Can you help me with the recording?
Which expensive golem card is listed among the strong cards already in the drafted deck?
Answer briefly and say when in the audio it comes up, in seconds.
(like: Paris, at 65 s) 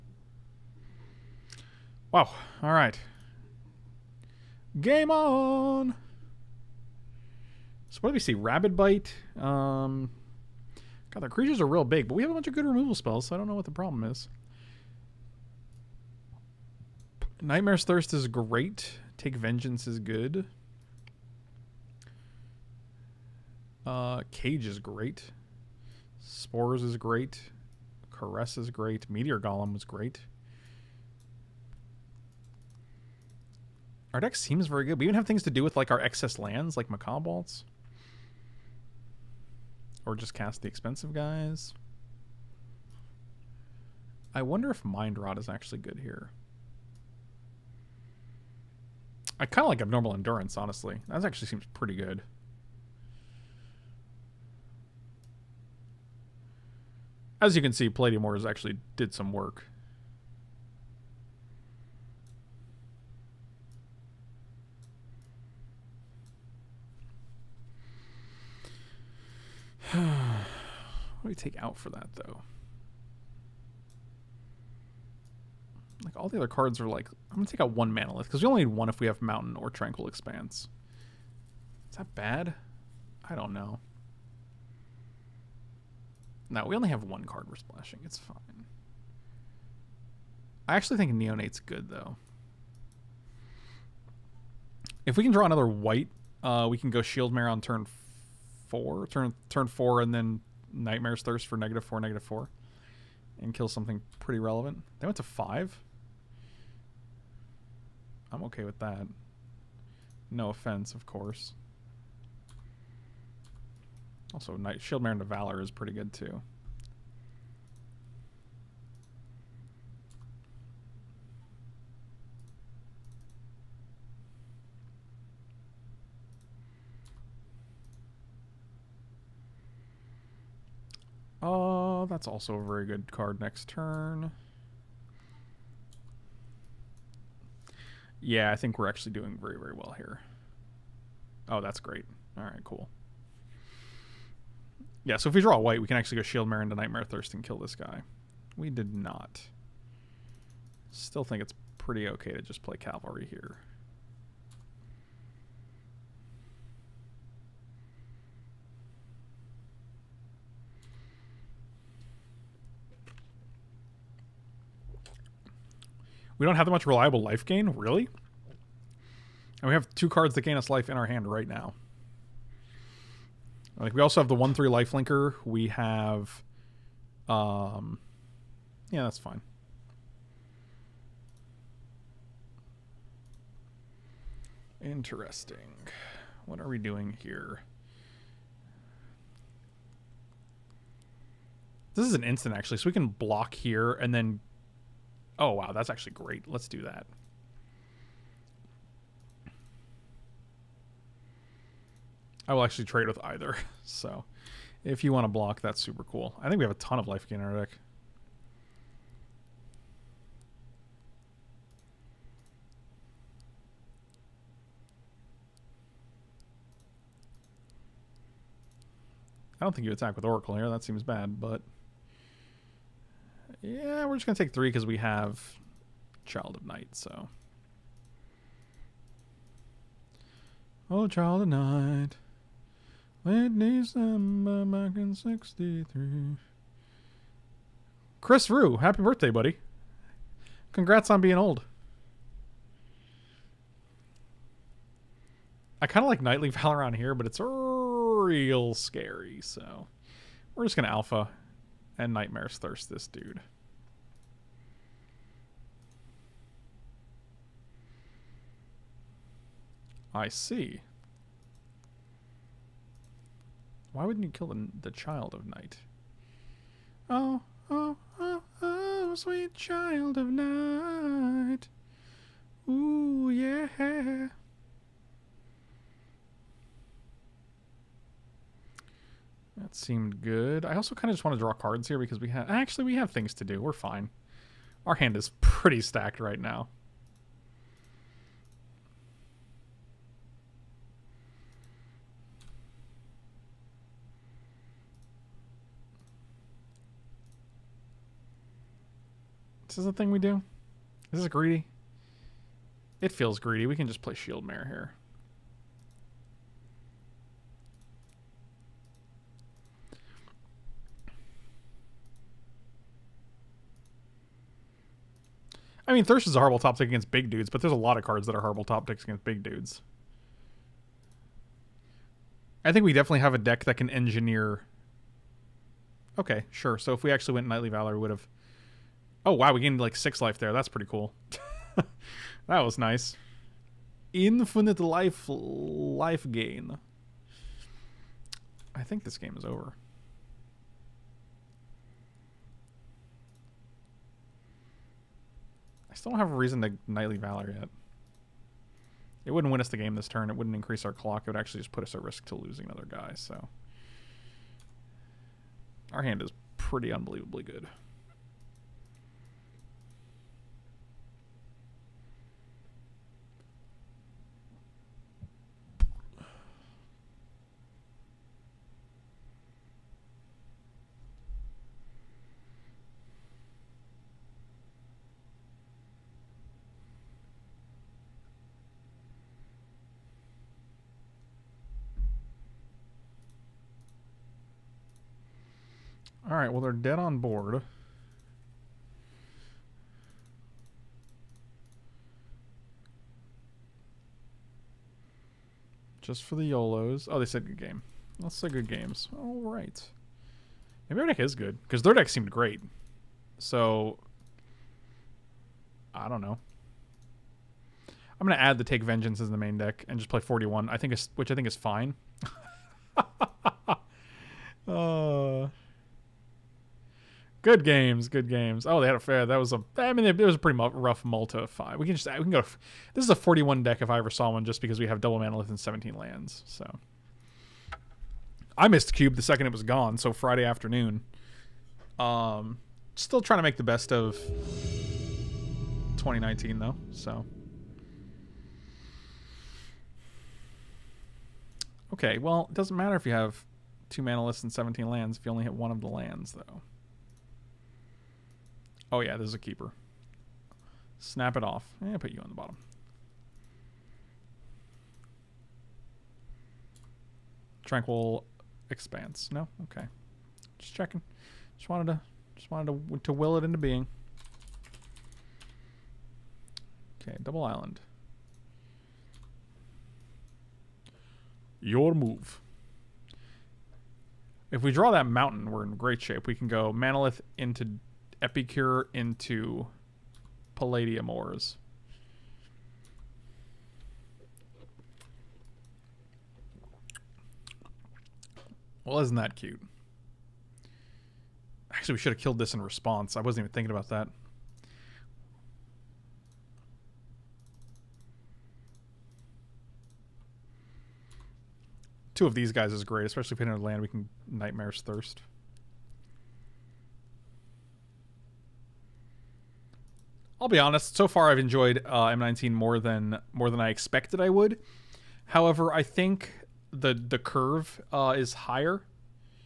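Meteor Golem, at 29 s.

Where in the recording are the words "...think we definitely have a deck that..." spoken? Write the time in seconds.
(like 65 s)
322 s.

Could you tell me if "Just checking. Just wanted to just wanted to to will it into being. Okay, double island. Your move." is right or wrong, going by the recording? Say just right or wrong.
right.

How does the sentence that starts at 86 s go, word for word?
No, we only have one card we're splashing.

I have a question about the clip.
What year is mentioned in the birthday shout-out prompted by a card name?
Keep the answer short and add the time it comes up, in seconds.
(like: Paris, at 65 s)
1963, at 235 s.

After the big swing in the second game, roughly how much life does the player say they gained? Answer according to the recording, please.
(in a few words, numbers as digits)
6.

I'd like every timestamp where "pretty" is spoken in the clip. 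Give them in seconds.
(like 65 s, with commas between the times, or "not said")
51 s, 104 s, 115 s, 151 s, 285 s, 330 s, 356 s, 420 s.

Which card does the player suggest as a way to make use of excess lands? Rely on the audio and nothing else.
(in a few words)
Macabre.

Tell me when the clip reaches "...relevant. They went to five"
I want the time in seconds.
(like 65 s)
104 s.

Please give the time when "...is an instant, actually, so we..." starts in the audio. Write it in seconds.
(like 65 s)
192 s.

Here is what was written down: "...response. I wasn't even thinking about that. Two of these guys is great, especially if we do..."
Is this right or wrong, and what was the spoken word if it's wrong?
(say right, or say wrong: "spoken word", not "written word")
right.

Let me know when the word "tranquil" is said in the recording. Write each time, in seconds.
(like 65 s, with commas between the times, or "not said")
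79 s, 457 s.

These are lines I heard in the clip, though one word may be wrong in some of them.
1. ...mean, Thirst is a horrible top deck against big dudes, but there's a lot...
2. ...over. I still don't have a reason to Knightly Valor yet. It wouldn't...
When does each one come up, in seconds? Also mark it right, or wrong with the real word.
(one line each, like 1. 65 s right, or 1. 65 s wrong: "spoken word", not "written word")
1. 315 s right
2. 339 s right.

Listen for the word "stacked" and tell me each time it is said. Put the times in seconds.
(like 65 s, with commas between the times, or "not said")
285 s.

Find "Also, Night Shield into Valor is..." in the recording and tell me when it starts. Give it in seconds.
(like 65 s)
114 s.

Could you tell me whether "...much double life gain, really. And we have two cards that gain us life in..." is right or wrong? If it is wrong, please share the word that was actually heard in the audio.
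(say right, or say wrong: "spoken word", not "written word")
wrong: "reliable", not "double".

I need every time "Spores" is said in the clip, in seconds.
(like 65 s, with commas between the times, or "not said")
26 s.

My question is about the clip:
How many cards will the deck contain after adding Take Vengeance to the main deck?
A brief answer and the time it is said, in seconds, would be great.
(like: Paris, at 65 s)
41, at 410 s.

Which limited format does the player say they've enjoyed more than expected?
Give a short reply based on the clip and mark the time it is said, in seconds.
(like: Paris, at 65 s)
M19, at 512 s.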